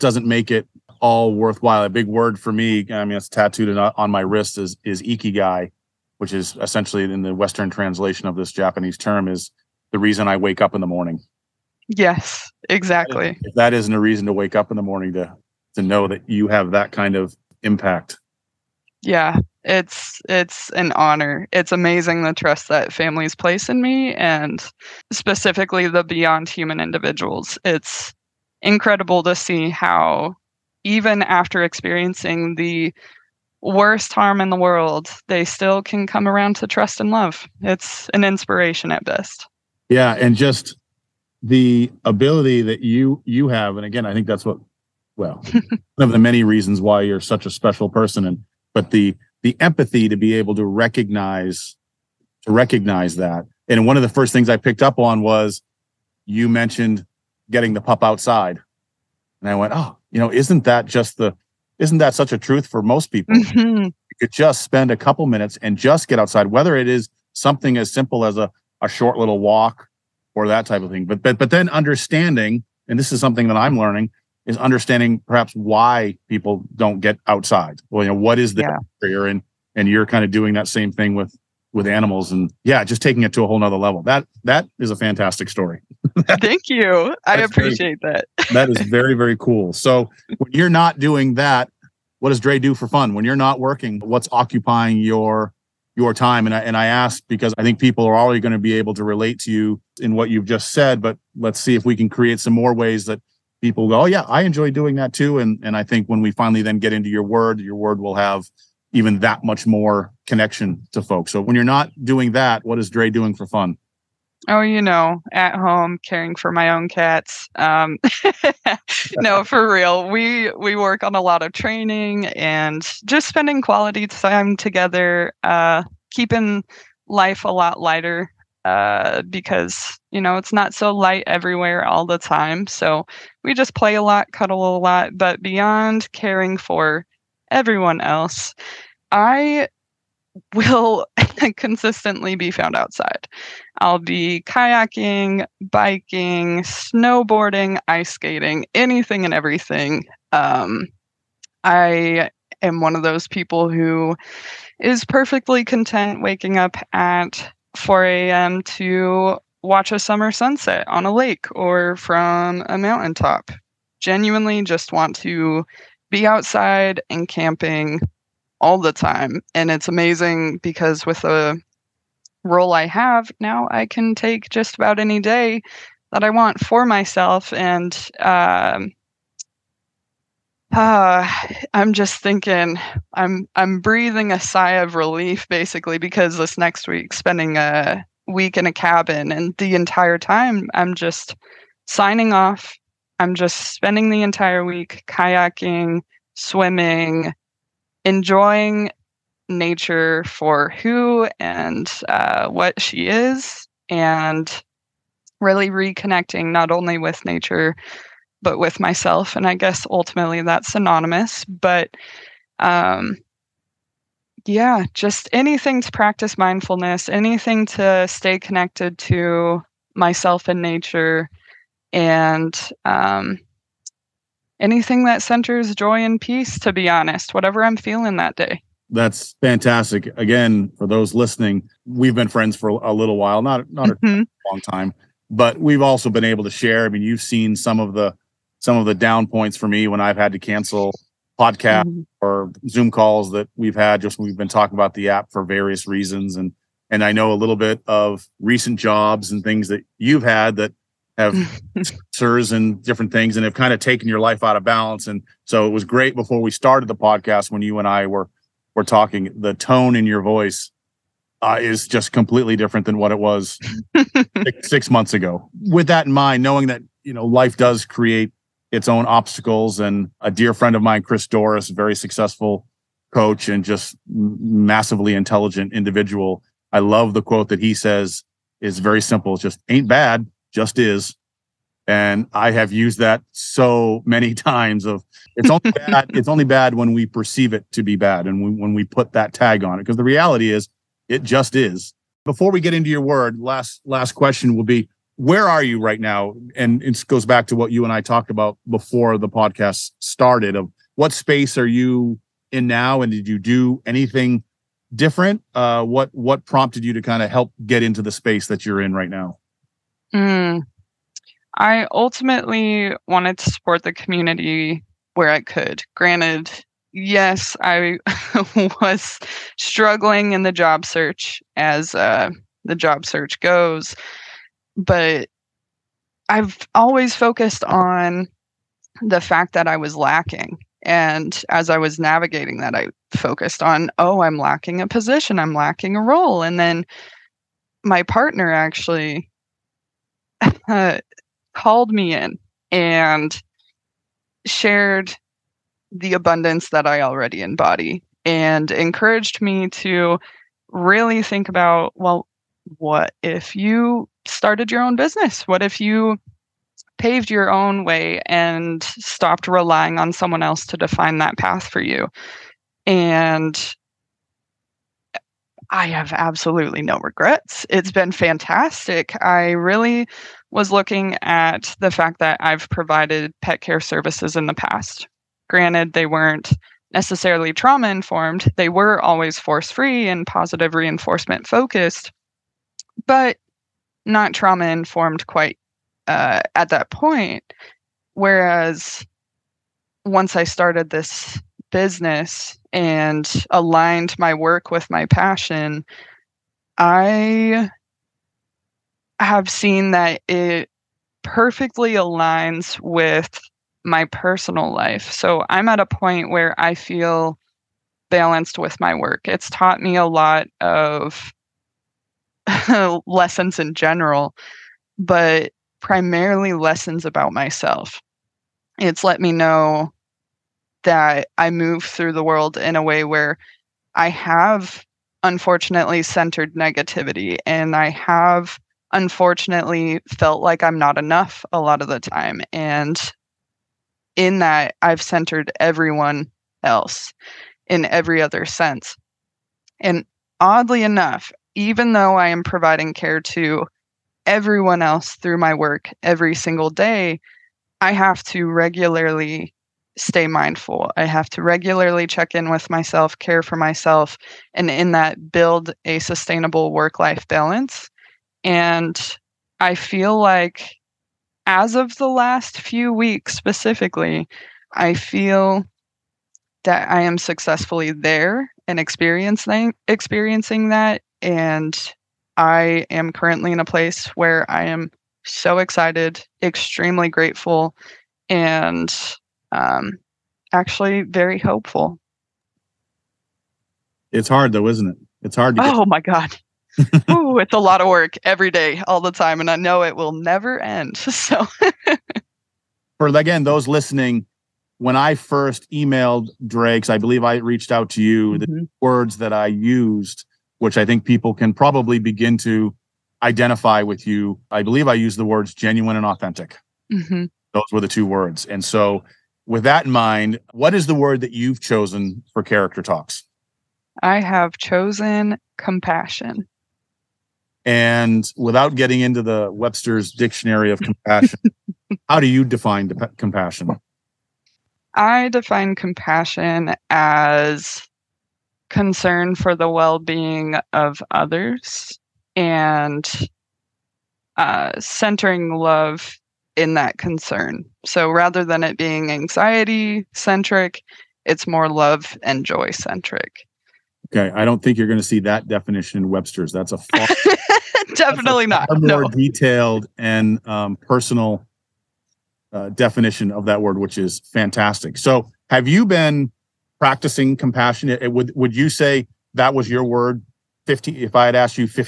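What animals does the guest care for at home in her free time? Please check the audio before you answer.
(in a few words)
cats.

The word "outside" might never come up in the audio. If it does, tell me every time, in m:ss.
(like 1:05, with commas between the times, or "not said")
0:58, 1:06, 1:17, 2:22, 2:46.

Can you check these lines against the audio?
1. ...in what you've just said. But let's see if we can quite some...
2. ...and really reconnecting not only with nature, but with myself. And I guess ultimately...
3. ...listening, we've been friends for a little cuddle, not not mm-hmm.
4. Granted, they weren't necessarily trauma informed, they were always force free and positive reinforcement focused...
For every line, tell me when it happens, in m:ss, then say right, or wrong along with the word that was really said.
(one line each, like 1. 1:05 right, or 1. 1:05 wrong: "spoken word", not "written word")
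1. 1:40 wrong: "create", not "quite"
2. 3:23 right
3. 3:51 wrong: "while", not "cuddle"
4. 6:15 right.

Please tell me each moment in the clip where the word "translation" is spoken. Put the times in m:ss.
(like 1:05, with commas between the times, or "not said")
0:07.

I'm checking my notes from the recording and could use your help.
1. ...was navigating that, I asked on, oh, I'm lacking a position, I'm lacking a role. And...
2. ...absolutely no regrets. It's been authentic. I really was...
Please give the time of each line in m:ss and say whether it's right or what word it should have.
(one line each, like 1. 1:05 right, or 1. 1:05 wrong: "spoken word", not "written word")
1. 5:31 wrong: "focused", not "asked"
2. 6:06 wrong: "fantastic", not "authentic".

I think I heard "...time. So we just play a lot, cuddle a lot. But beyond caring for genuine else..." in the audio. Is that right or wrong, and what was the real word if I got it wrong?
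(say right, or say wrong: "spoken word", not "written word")
wrong: "everyone", not "genuine".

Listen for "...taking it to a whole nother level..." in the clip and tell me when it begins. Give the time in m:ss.
1:23.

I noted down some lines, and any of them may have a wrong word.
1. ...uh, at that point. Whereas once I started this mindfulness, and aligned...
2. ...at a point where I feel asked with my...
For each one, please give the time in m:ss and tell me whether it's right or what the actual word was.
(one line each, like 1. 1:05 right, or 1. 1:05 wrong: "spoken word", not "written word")
1. 6:26 wrong: "business", not "mindfulness"
2. 6:45 wrong: "balanced", not "asked".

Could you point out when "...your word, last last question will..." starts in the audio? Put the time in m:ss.
4:52.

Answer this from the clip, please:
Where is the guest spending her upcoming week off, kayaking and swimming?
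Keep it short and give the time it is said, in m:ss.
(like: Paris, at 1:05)
a cabin, at 3:08.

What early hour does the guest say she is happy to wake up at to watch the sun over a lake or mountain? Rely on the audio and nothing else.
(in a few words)
4 a.m.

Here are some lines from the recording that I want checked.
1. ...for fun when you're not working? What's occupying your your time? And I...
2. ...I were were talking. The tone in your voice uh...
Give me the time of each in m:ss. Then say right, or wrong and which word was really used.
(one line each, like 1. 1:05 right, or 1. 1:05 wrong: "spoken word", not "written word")
1. 1:32 right
2. 4:17 right.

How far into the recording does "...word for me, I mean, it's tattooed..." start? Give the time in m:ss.
0:02.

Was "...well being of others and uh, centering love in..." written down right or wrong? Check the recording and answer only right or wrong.
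right.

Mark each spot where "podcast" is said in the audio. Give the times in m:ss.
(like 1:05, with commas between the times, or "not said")
4:01, 4:16, 4:59.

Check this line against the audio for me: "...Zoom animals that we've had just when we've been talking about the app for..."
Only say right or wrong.
wrong.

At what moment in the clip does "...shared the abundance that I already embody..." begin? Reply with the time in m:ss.
5:44.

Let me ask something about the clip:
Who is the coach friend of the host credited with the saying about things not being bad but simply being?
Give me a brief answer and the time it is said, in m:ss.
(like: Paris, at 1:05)
Chris Doris, at 4:31.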